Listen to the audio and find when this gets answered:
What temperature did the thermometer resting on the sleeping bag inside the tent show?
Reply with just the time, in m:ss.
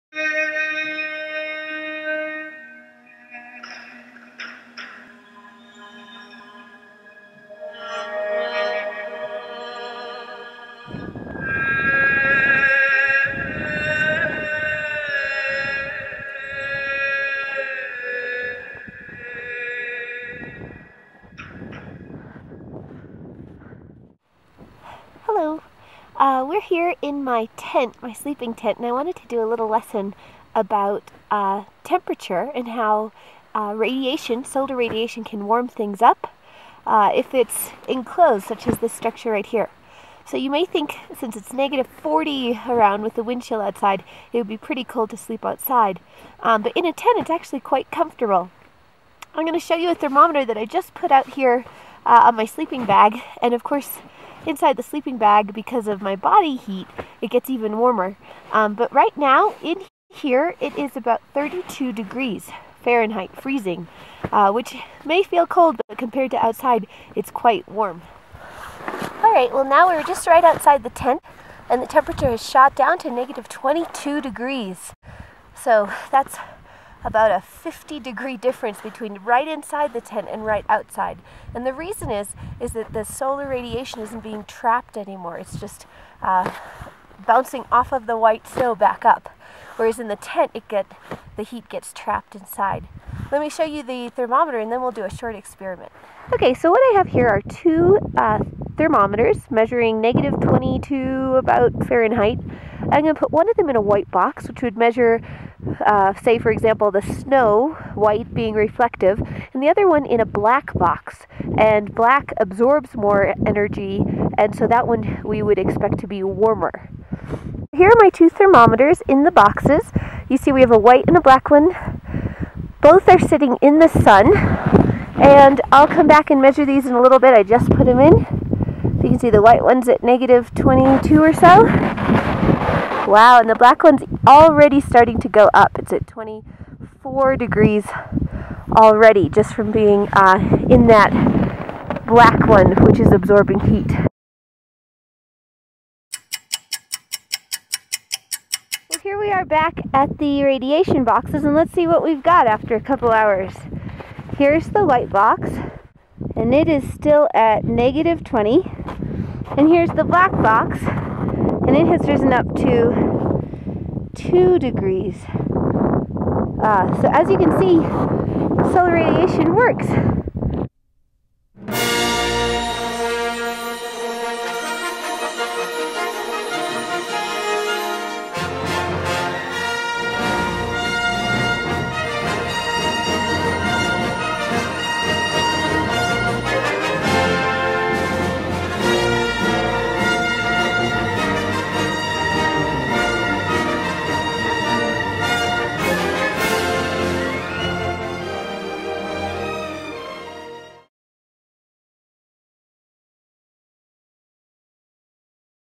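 1:01.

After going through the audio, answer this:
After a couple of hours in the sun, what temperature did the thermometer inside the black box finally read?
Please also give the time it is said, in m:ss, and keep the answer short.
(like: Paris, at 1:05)
2 degrees, at 2:44.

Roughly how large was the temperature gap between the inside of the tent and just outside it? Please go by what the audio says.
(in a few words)
50 degrees.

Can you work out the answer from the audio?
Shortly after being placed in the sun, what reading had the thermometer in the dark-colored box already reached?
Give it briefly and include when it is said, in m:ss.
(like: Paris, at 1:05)
24 degrees, at 2:16.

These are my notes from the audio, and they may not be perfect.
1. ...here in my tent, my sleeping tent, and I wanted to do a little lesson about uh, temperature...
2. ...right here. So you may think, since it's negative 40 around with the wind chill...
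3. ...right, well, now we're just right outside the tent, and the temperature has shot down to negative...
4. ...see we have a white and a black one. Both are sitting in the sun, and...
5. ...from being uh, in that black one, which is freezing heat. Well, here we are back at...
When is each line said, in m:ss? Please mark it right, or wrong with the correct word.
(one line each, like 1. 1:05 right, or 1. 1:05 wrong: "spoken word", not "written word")
1. 0:26 right
2. 0:39 right
3. 1:09 right
4. 2:00 right
5. 2:19 wrong: "absorbing", not "freezing".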